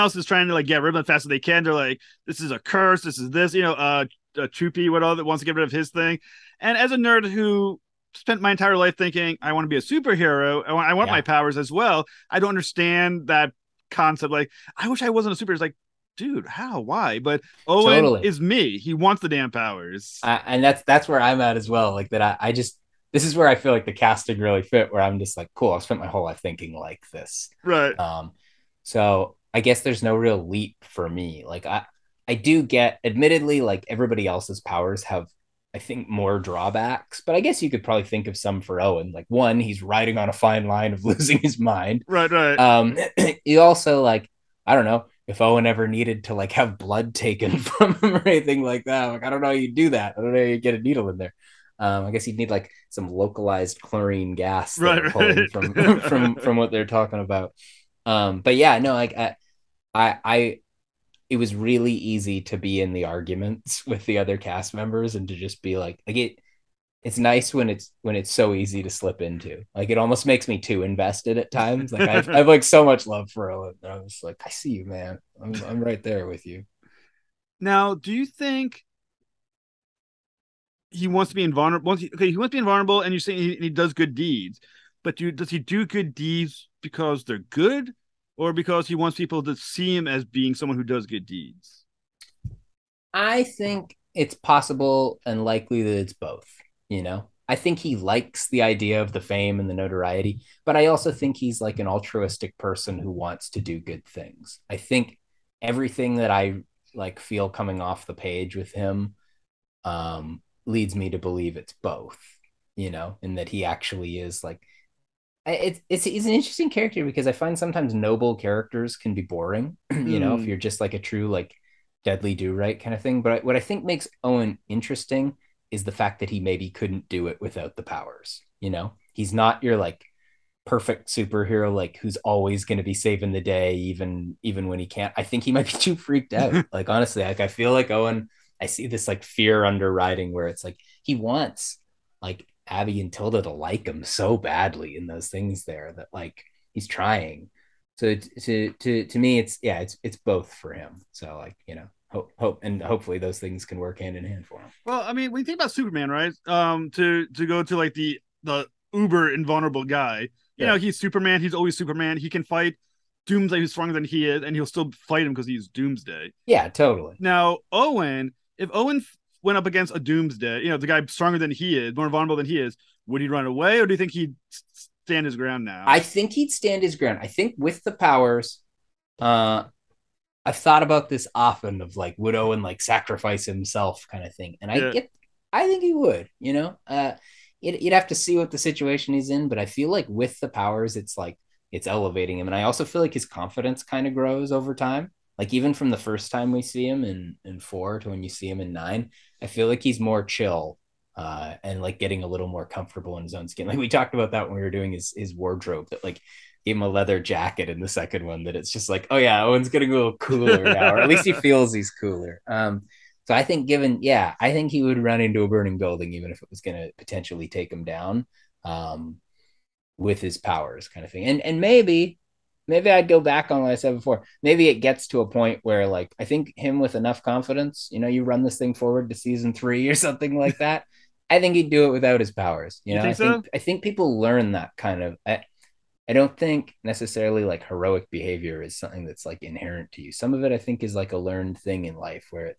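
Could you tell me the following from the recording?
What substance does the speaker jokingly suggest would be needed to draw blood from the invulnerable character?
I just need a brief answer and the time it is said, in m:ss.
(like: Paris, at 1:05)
chlorine gas, at 0:53.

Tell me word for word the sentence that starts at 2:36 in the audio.
Um, to to go to like the the uber invulnerable guy, you yeah.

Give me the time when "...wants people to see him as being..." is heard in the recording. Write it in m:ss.
1:28.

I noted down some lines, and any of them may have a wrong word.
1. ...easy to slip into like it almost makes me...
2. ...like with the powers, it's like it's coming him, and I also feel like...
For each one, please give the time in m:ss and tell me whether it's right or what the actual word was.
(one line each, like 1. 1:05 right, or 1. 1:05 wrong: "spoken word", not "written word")
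1. 1:08 right
2. 3:09 wrong: "elevating", not "coming".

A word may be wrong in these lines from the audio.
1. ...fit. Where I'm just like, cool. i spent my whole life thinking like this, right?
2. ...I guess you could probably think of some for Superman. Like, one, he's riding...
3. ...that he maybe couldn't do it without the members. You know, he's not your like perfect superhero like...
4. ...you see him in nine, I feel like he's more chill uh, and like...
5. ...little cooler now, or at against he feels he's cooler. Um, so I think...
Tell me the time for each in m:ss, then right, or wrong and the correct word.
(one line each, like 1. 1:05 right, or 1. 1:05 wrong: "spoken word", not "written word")
1. 0:24 right
2. 0:37 wrong: "Owen", not "Superman"
3. 2:06 wrong: "powers", not "members"
4. 3:18 right
5. 3:29 wrong: "least", not "against".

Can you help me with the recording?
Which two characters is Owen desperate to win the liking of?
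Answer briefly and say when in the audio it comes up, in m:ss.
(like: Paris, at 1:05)
Abby and Tilda, at 2:22.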